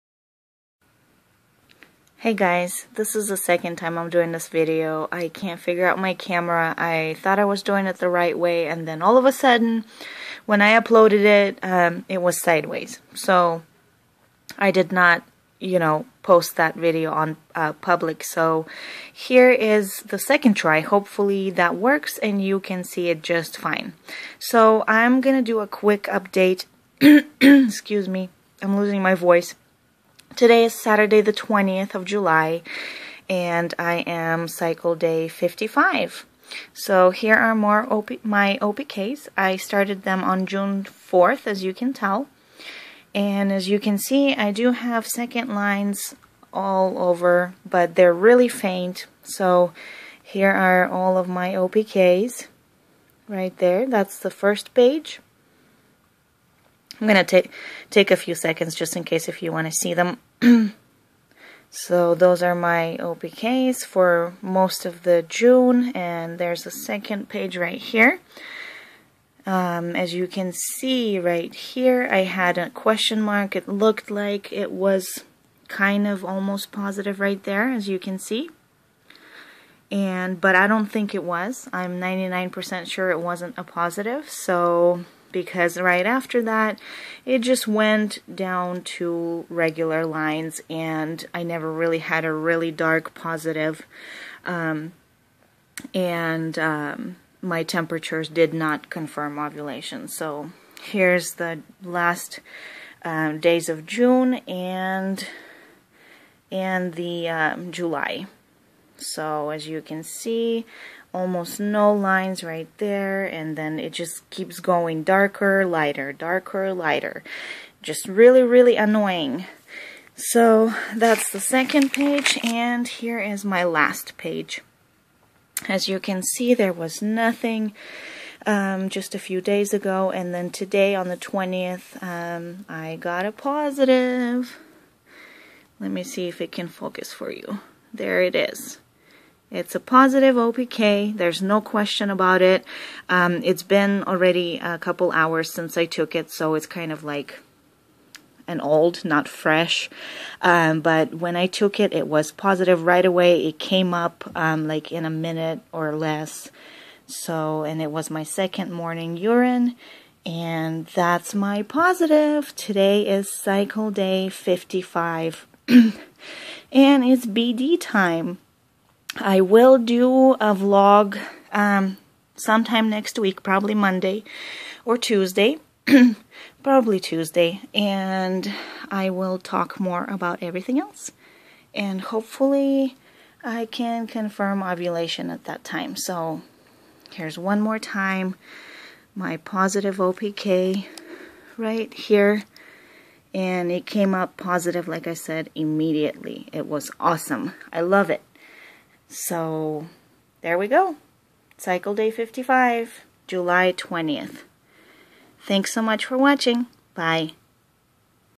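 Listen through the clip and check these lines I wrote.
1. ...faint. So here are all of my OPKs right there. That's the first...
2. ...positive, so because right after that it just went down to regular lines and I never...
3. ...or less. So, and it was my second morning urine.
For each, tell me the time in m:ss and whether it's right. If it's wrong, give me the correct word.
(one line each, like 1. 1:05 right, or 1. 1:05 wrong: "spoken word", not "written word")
1. 0:48 right
2. 1:23 right
3. 2:35 right.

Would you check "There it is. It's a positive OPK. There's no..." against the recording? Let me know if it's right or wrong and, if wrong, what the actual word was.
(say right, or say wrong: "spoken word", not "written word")
right.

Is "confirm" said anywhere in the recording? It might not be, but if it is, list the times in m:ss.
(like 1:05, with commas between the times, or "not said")
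1:38, 3:04.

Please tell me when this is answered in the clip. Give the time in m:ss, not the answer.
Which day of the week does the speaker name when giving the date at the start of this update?
0:30.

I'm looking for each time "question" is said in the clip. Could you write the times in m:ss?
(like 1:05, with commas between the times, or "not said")
1:12, 2:21.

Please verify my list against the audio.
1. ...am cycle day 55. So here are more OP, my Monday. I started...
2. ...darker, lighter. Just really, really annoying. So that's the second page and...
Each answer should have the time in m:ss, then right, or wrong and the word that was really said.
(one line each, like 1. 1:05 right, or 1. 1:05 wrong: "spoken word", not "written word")
1. 0:34 wrong: "OPKs", not "Monday"
2. 1:56 right.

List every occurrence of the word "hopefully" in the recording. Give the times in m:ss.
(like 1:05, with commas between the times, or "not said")
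0:20, 3:02.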